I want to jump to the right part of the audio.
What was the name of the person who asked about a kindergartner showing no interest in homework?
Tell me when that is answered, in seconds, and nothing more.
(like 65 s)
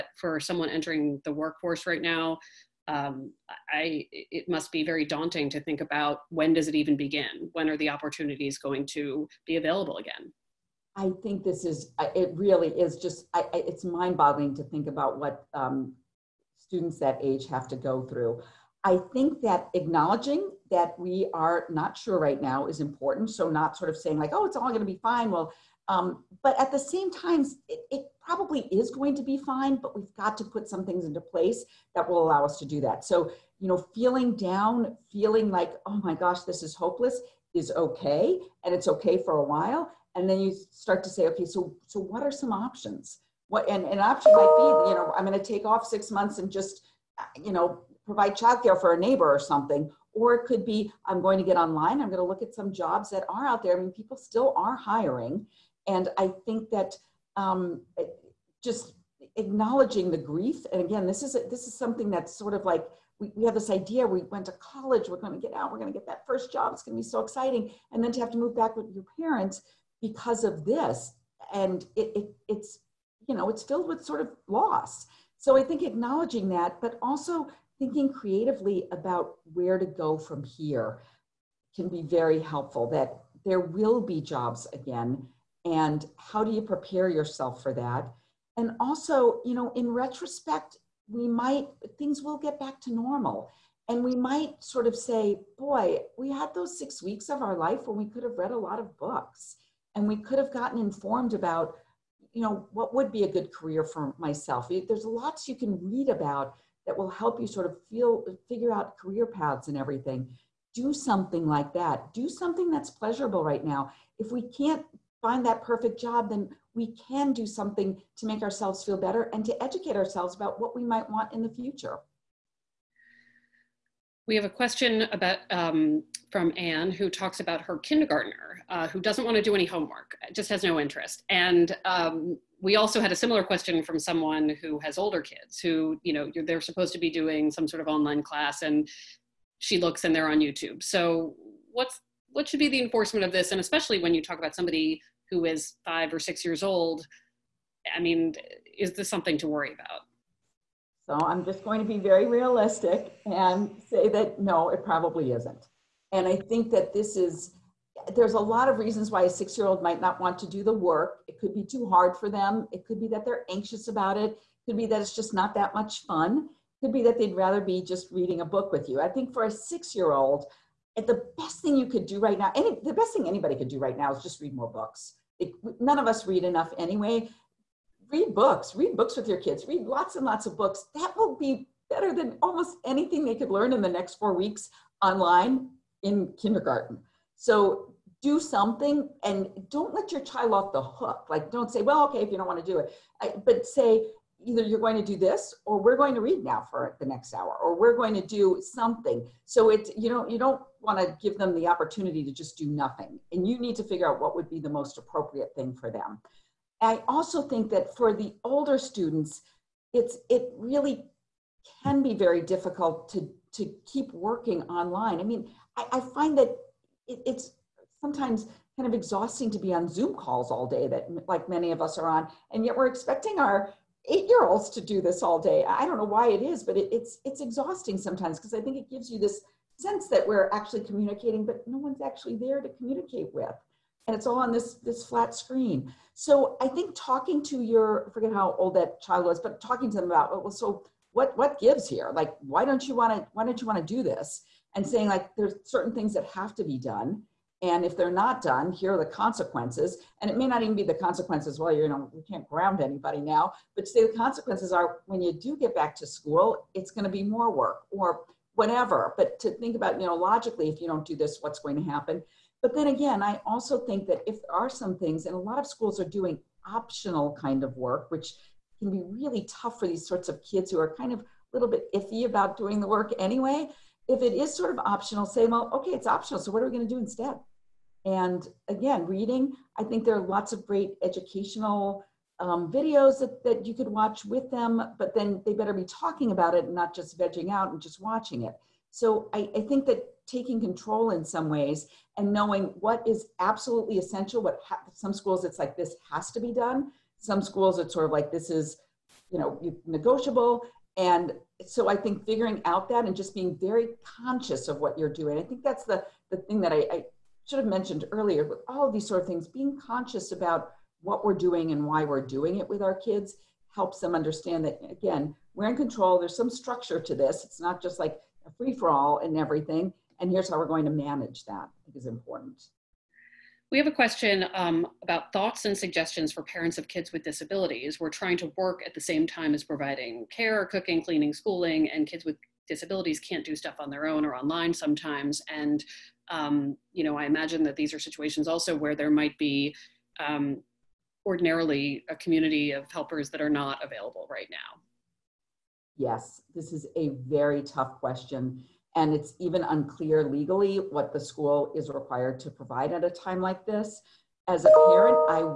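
126 s.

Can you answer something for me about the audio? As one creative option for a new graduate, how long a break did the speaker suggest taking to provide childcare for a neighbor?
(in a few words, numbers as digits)
6 months.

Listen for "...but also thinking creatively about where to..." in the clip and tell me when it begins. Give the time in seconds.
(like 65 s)
76 s.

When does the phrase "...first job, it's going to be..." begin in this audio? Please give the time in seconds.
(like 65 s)
66 s.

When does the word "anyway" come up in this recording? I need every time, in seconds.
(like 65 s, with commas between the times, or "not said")
176 s, 273 s.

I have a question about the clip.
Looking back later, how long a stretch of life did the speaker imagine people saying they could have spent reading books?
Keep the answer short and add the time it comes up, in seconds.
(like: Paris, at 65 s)
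6 weeks, at 96 s.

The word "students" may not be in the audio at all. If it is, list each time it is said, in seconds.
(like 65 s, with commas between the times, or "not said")
16 s, 208 s.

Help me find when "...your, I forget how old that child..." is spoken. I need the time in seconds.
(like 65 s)
237 s.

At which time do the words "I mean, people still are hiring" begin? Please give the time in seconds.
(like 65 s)
53 s.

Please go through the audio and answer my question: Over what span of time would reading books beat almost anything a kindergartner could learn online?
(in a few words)
4 weeks.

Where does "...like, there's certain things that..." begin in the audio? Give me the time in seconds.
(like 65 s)
245 s.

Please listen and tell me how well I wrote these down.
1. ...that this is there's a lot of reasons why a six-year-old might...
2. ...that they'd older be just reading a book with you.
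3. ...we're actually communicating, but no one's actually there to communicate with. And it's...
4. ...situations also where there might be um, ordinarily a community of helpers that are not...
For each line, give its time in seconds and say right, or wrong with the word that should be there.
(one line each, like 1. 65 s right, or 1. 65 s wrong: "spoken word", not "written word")
1. 156 s right
2. 167 s wrong: "rather", not "older"
3. 230 s right
4. 337 s right.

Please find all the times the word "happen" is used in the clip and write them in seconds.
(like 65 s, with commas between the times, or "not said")
261 s.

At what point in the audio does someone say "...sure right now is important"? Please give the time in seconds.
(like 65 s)
21 s.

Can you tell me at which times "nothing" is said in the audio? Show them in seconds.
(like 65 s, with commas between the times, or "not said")
202 s.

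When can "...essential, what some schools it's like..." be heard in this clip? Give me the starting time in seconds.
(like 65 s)
293 s.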